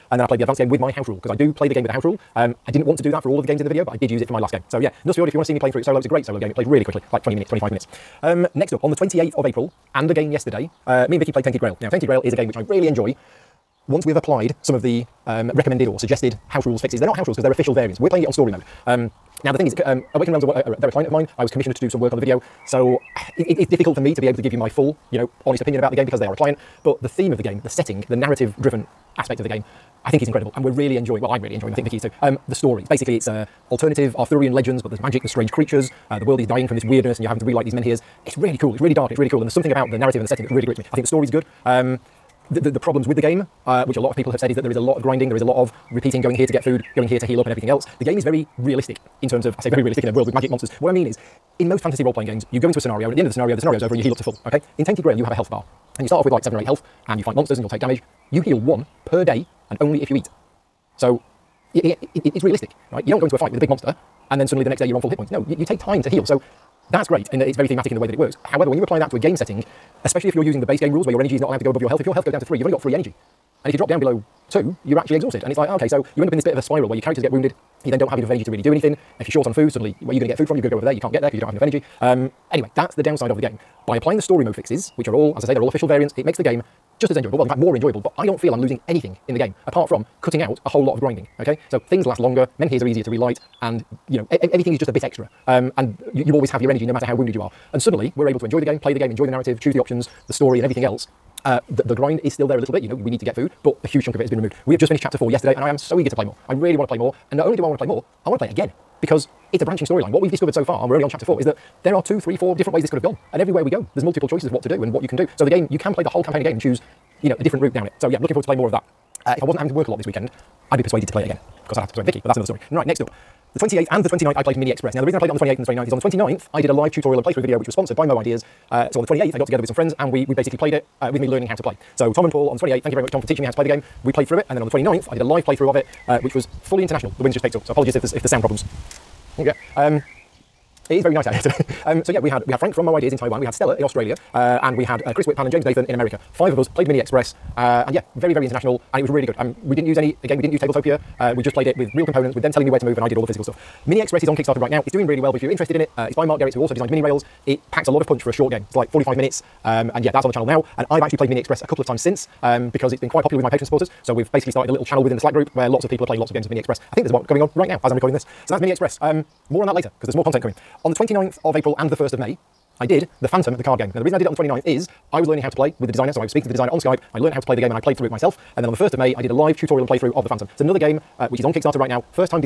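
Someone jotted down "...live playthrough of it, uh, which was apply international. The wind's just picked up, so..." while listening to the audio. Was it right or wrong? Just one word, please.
wrong.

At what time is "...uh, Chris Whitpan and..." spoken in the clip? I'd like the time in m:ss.
2:25.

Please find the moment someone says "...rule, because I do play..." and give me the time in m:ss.
0:01.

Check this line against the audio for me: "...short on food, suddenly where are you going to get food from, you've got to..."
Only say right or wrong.
right.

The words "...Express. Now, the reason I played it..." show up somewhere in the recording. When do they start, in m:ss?
2:04.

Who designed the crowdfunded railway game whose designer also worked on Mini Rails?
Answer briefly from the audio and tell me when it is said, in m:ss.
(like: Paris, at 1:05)
Mark Gerrits, at 2:36.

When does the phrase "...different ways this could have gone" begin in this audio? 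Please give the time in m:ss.
1:52.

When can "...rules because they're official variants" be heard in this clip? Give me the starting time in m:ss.
0:17.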